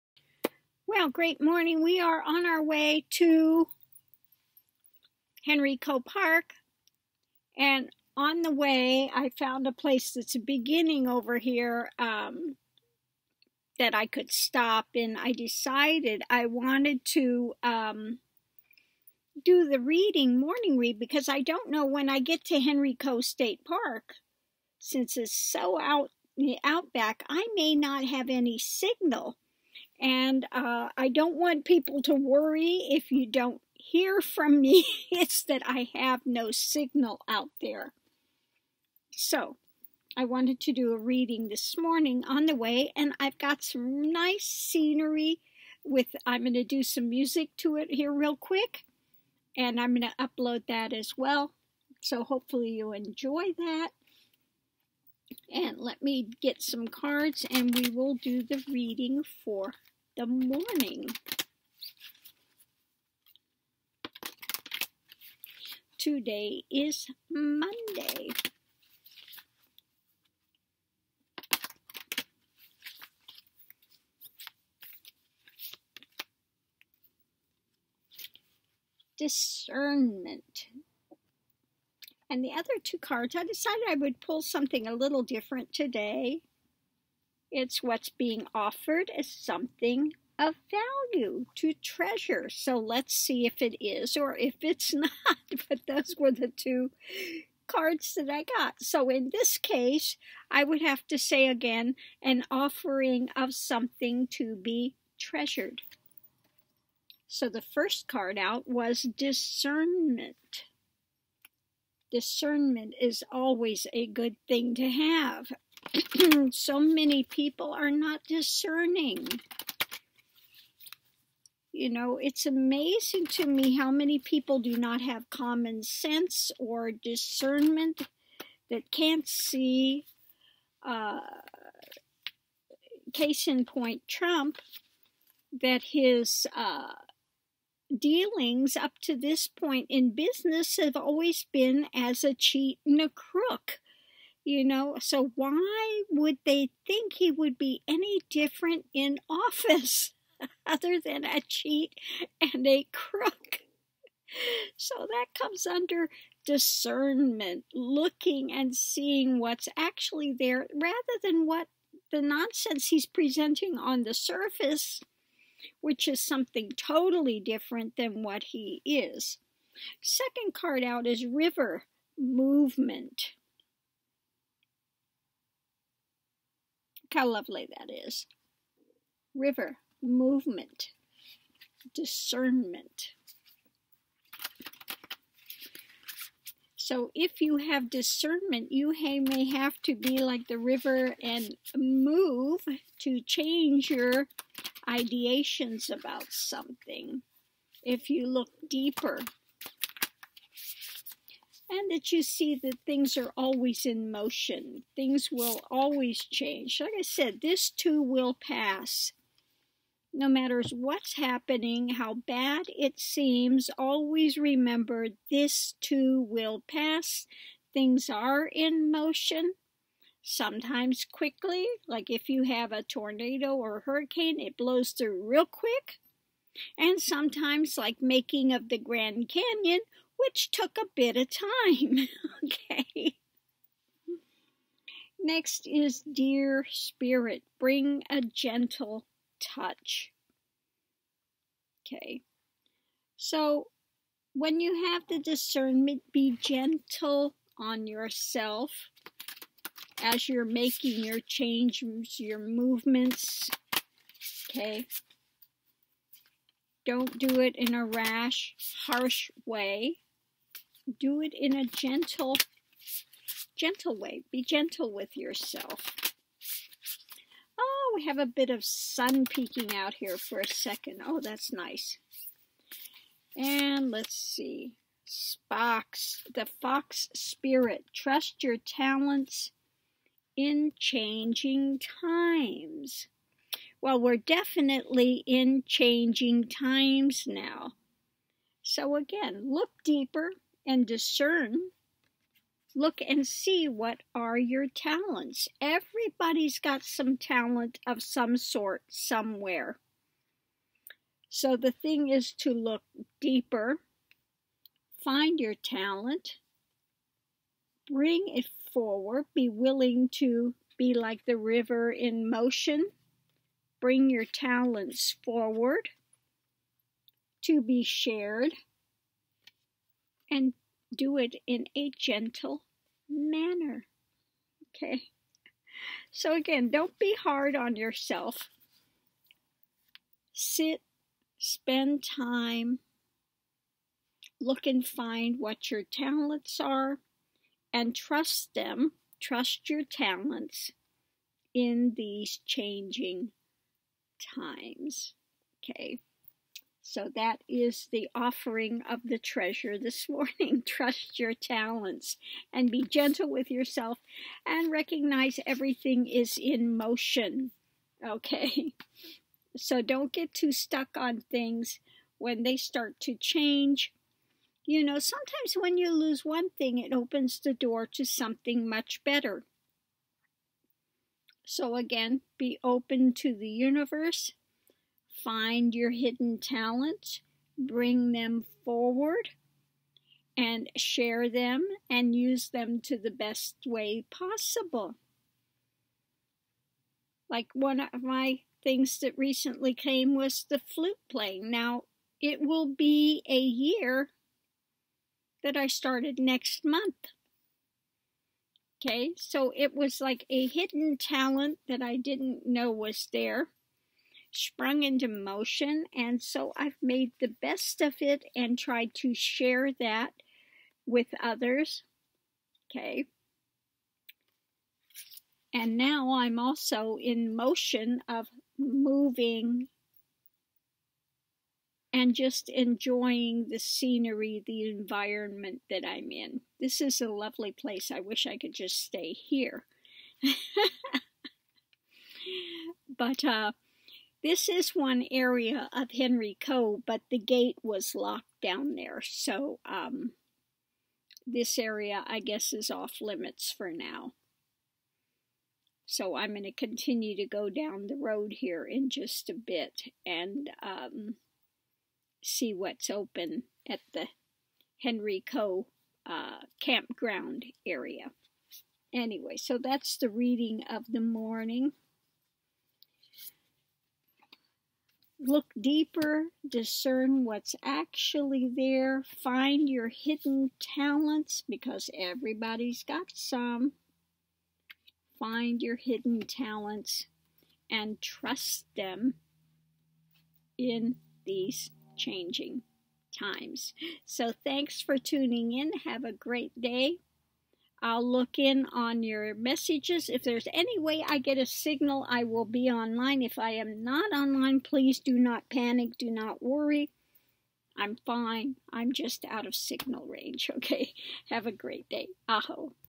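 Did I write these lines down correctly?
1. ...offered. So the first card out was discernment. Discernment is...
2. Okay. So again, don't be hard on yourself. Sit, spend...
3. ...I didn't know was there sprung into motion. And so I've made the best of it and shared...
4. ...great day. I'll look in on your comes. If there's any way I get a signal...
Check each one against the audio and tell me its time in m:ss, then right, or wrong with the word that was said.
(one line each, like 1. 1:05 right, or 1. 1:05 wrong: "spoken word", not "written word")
1. 1:45 wrong: "treasured", not "offered"
2. 5:24 right
3. 6:41 wrong: "tried", not "shared"
4. 8:06 wrong: "messages", not "comes".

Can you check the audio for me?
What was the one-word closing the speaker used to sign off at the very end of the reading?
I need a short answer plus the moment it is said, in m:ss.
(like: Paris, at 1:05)
Aho, at 8:22.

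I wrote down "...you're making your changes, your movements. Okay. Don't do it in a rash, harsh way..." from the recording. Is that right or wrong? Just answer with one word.
right.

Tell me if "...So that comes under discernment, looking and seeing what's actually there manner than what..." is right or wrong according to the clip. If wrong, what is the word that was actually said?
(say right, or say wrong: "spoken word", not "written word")
wrong: "rather", not "manner".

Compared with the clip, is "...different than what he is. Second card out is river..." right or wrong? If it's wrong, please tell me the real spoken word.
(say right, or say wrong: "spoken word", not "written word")
right.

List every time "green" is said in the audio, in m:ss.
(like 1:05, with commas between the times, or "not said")
not said.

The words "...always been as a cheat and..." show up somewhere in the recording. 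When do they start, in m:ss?
2:20.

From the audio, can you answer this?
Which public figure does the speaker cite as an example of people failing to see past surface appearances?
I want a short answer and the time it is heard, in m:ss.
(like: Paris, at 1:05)
Trump, at 2:14.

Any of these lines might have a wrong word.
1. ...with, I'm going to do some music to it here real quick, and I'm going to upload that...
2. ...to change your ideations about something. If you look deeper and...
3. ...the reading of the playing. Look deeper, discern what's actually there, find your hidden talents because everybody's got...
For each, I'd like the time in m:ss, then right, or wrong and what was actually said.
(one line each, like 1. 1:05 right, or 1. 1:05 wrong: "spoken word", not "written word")
1. 0:45 right
2. 3:12 right
3. 7:39 wrong: "morning", not "playing".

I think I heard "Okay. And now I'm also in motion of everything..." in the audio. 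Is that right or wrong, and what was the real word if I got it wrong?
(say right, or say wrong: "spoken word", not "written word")
wrong: "moving", not "everything".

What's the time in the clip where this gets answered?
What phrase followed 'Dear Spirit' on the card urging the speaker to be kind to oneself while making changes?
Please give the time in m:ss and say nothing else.
3:57.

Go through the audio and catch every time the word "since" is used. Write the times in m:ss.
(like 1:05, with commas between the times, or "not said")
0:24.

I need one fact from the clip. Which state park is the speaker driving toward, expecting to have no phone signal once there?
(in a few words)
Henry Coe State Park.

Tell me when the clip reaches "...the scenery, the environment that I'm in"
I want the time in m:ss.
7:03.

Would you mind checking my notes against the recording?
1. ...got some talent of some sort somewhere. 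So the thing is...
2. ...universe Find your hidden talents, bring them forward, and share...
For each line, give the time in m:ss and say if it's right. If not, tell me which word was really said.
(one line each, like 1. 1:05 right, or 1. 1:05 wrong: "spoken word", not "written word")
1. 4:56 right
2. 6:13 right.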